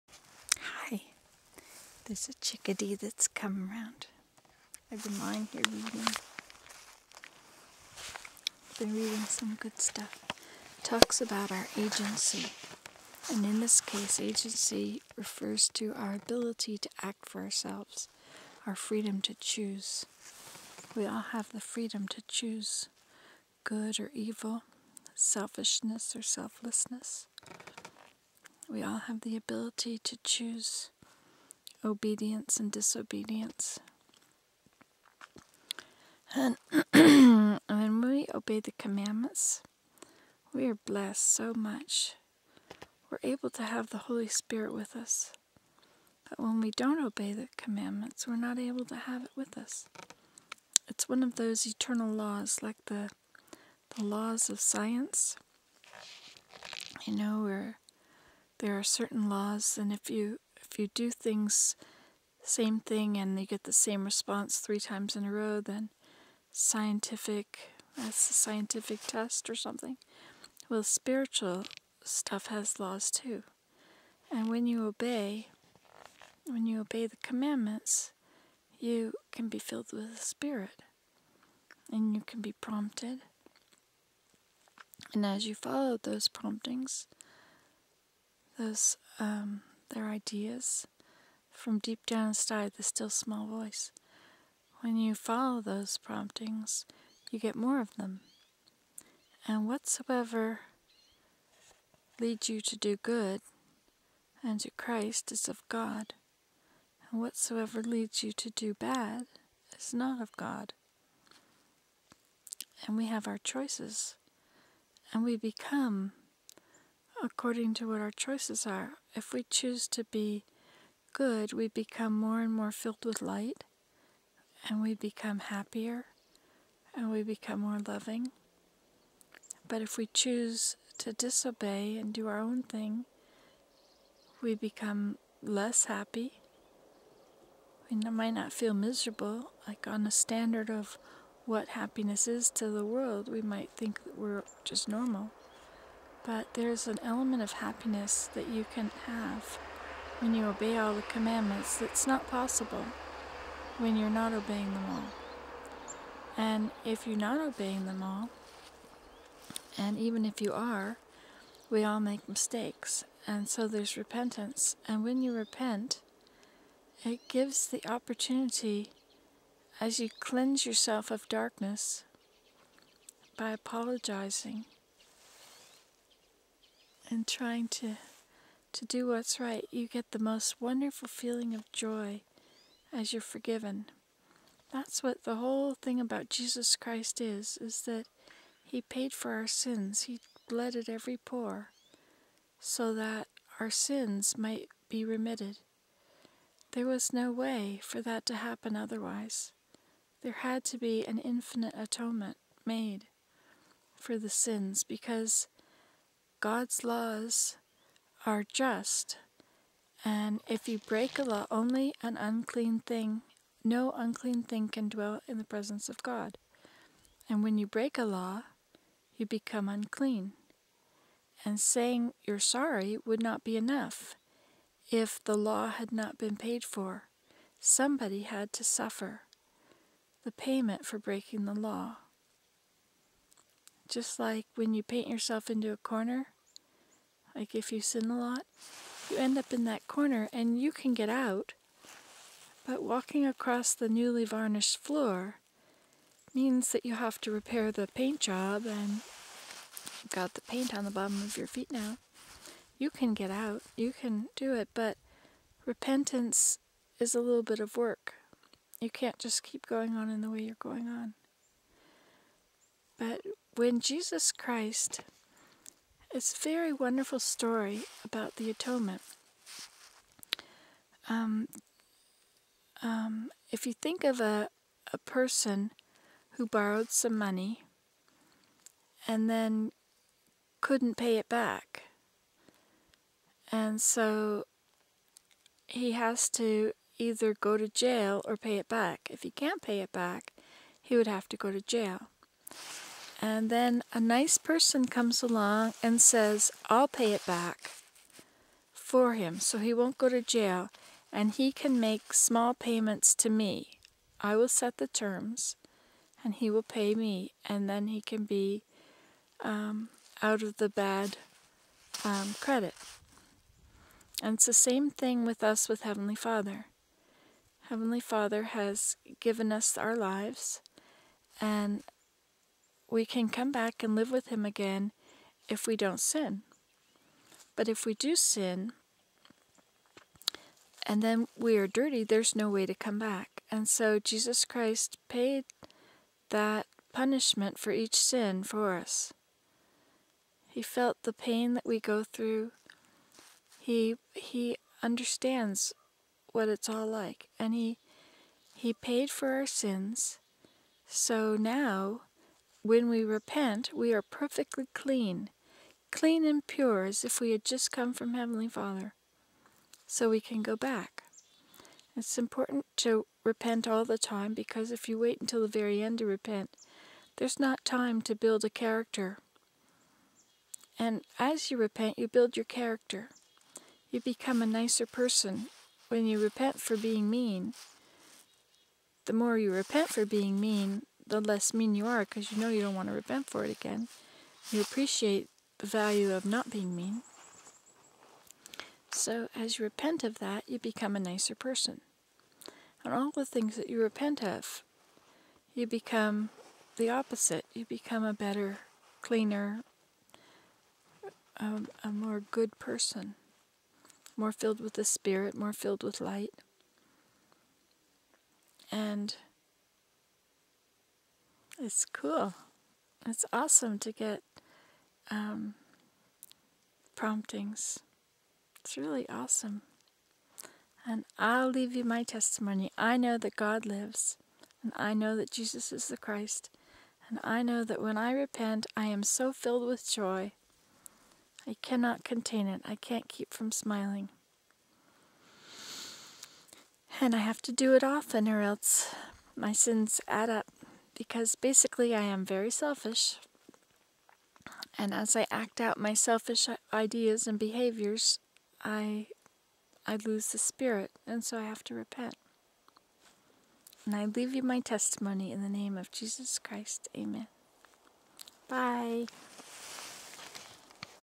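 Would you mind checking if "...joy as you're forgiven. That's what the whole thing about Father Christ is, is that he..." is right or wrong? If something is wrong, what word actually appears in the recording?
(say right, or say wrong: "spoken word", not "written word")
wrong: "Jesus", not "Father".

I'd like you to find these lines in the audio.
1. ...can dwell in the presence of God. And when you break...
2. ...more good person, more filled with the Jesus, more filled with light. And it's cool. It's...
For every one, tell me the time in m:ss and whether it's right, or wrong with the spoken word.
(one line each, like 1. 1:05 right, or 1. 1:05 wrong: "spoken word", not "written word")
1. 3:34 right
2. 6:41 wrong: "Spirit", not "Jesus".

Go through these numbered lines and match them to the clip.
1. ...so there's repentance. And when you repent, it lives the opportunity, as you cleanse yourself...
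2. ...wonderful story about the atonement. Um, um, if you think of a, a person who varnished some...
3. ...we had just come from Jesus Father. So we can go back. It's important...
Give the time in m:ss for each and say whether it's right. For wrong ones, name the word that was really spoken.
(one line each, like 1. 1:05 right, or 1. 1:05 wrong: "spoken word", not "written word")
1. 2:43 wrong: "gives", not "lives"
2. 4:26 wrong: "borrowed", not "varnished"
3. 5:57 wrong: "Heavenly", not "Jesus".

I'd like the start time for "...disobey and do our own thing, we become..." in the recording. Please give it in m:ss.
2:11.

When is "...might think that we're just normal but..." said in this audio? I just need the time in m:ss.
2:23.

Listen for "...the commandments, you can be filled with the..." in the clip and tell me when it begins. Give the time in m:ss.
1:17.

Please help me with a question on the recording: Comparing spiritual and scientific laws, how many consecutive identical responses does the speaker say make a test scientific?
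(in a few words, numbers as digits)
3.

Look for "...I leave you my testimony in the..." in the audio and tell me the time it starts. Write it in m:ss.
7:33.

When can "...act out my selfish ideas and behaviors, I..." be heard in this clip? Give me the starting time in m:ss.
7:25.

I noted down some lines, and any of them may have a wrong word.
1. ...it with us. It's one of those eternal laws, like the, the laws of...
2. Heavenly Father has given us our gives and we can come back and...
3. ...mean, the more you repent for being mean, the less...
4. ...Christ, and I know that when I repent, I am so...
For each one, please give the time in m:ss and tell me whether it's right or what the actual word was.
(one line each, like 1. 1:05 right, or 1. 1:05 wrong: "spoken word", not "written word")
1. 0:49 right
2. 5:17 wrong: "lives", not "gives"
3. 6:17 right
4. 7:05 right.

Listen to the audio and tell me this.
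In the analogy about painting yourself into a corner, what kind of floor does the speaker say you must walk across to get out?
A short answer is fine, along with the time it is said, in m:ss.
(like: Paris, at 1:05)
newly varnished floor, at 4:03.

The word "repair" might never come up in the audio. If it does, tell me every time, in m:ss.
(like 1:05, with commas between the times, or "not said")
4:07.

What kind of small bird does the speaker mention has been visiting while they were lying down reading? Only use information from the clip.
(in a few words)
chickadee.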